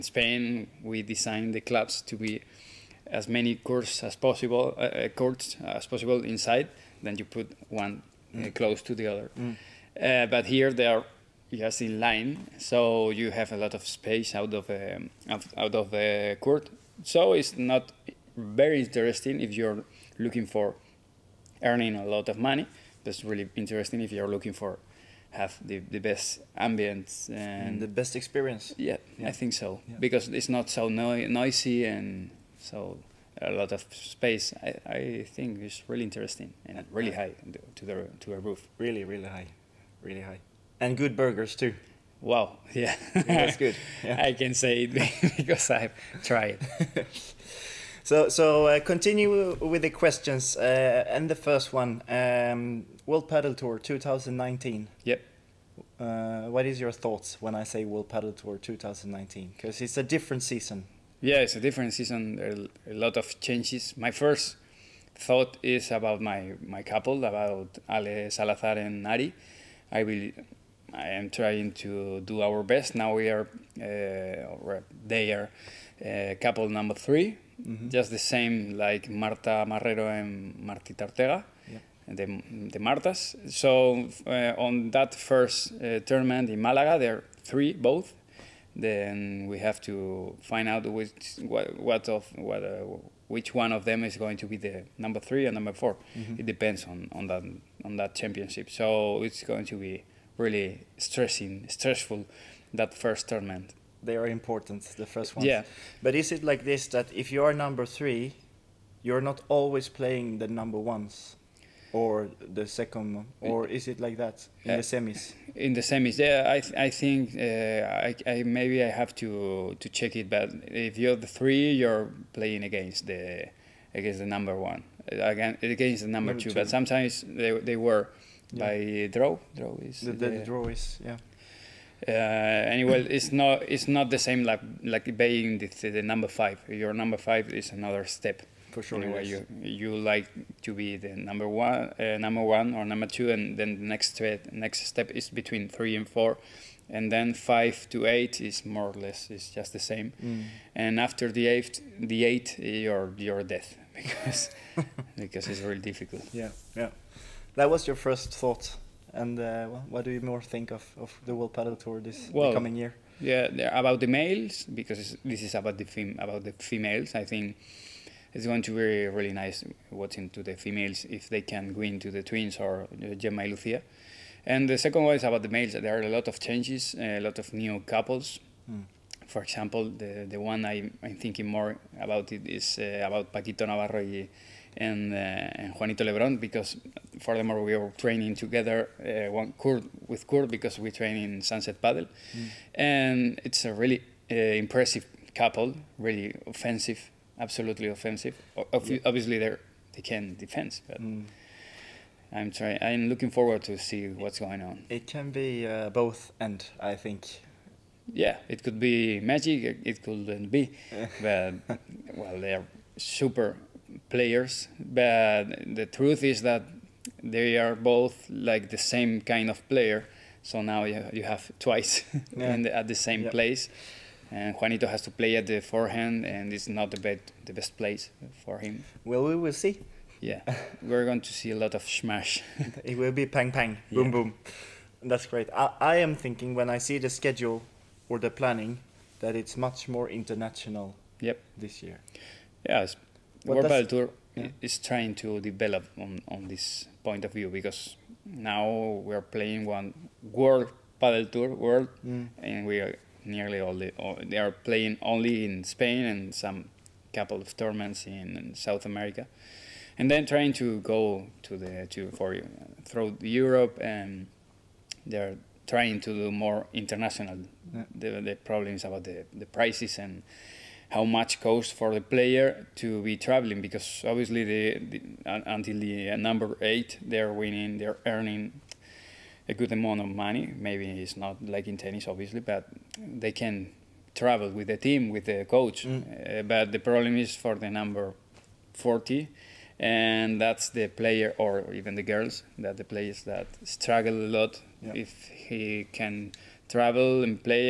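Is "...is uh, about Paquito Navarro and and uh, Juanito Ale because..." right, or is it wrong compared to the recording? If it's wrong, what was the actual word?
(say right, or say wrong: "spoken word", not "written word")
wrong: "Lebron", not "Ale".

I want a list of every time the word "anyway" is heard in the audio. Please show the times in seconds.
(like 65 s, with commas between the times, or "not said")
132 s, 139 s.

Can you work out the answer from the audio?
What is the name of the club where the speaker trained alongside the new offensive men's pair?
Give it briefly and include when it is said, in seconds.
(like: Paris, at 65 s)
Sunset Padel, at 191 s.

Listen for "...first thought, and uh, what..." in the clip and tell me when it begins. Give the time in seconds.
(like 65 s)
157 s.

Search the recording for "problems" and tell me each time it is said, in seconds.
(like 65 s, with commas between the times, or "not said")
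268 s, 286 s.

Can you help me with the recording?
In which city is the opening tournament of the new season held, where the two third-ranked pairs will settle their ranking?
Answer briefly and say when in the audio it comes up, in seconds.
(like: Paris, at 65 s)
Malaga, at 86 s.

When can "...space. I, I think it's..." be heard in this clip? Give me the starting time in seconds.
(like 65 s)
33 s.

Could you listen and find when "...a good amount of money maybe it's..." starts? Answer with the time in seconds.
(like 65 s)
279 s.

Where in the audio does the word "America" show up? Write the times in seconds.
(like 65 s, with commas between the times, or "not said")
258 s.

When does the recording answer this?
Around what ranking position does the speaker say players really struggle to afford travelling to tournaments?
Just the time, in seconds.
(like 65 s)
287 s.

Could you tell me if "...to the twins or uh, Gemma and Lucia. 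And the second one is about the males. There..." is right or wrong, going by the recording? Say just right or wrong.
right.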